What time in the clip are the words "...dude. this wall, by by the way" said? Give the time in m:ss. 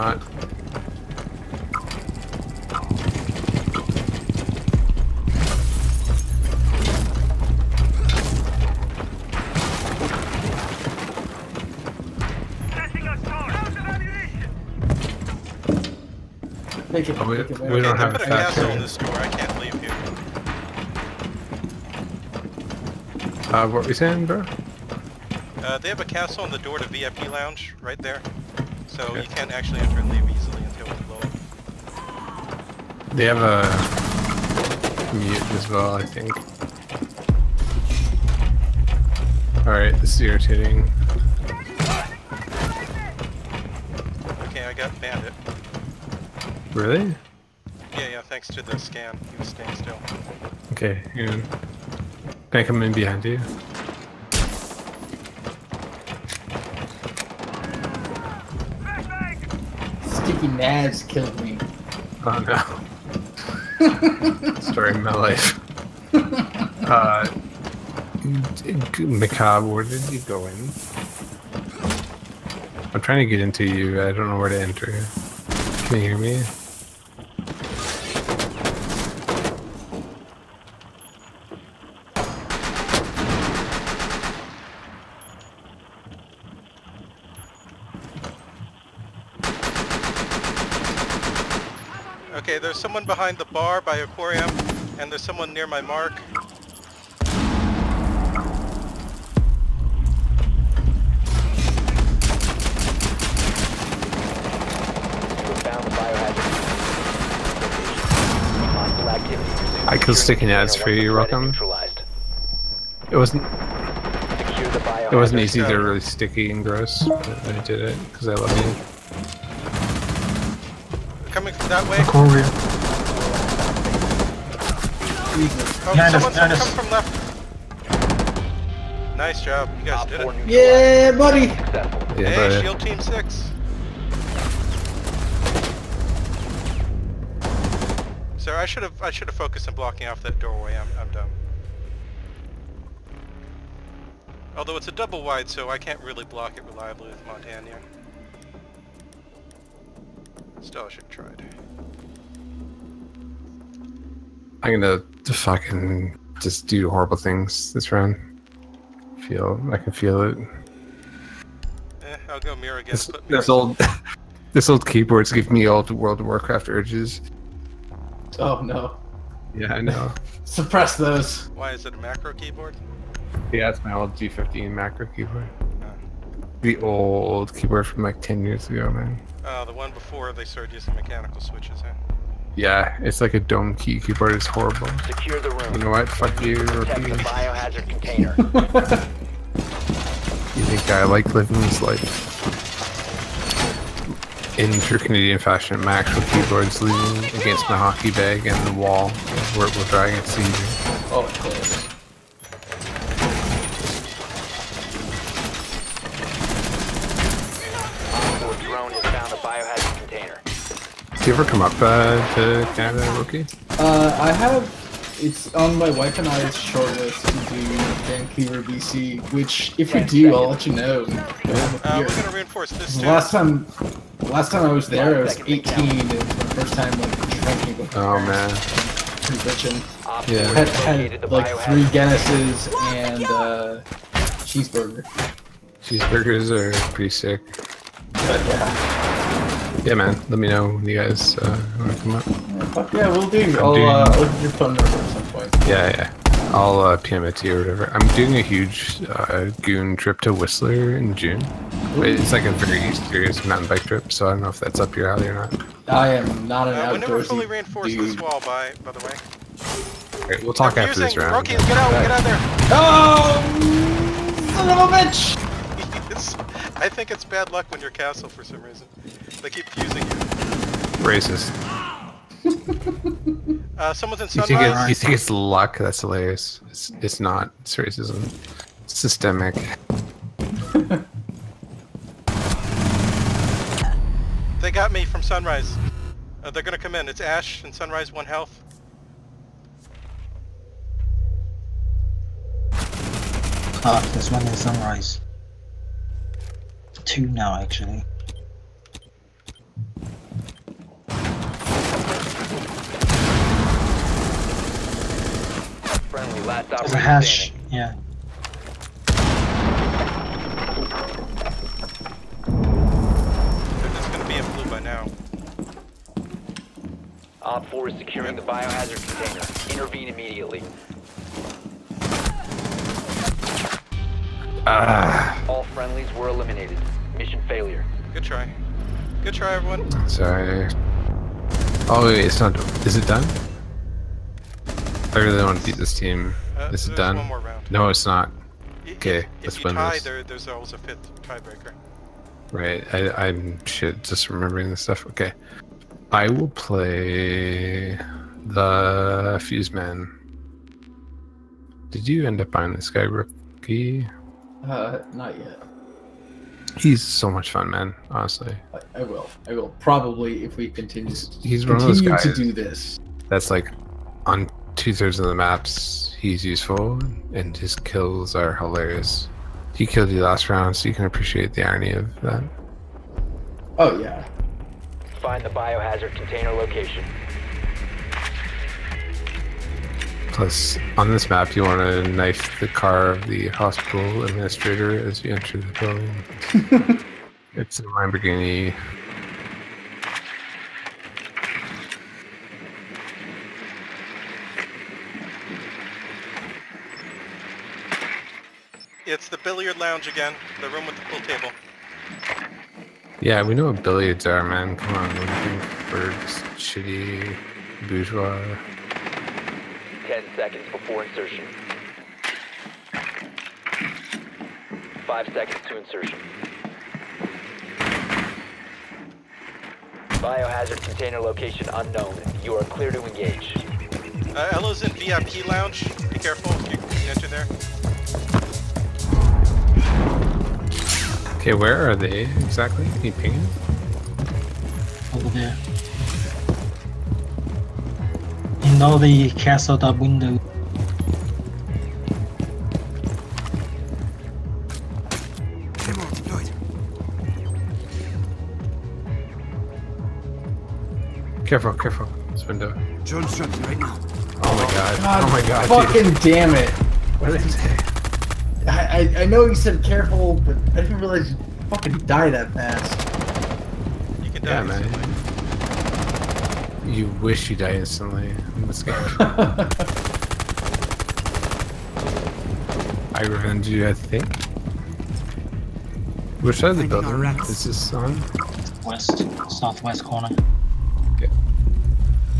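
4:17.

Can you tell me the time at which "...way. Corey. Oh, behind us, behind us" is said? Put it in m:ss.
2:01.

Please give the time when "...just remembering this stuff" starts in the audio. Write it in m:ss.
5:44.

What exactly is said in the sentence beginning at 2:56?
The old keyboard from like 10 years ago, man.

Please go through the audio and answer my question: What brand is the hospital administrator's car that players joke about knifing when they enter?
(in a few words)
Lamborghini.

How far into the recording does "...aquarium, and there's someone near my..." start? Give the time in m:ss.
1:33.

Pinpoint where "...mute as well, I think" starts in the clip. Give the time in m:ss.
0:35.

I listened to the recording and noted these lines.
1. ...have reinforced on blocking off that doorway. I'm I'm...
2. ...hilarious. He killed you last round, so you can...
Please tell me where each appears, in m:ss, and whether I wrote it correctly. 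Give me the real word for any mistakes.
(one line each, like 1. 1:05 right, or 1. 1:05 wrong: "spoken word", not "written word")
1. 2:19 wrong: "focused", not "reinforced"
2. 6:08 right.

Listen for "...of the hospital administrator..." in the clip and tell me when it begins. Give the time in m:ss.
6:23.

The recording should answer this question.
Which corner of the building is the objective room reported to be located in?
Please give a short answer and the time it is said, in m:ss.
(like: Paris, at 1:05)
Southwest, at 7:59.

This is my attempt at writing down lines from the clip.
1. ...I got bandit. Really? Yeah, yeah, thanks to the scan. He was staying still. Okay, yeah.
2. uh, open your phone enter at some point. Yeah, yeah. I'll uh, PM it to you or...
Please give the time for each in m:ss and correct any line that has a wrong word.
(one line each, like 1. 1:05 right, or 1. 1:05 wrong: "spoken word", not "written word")
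1. 0:44 right
2. 4:03 wrong: "number", not "enter".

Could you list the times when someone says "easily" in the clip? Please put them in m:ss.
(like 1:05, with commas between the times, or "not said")
0:30.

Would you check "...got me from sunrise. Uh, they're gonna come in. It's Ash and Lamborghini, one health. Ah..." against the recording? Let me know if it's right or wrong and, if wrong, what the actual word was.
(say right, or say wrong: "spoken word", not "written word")
wrong: "Sunrise", not "Lamborghini".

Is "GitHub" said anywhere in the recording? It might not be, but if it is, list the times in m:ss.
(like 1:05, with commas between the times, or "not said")
not said.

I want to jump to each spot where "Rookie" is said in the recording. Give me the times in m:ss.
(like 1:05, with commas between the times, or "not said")
3:33, 4:21, 5:53.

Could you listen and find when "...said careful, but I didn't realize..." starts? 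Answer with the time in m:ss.
7:39.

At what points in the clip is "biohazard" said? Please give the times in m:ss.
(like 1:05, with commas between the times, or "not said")
3:07, 5:18, 6:15, 7:00.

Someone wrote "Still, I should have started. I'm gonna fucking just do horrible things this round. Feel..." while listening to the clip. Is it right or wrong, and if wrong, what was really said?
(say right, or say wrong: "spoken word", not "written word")
wrong: "tried", not "started".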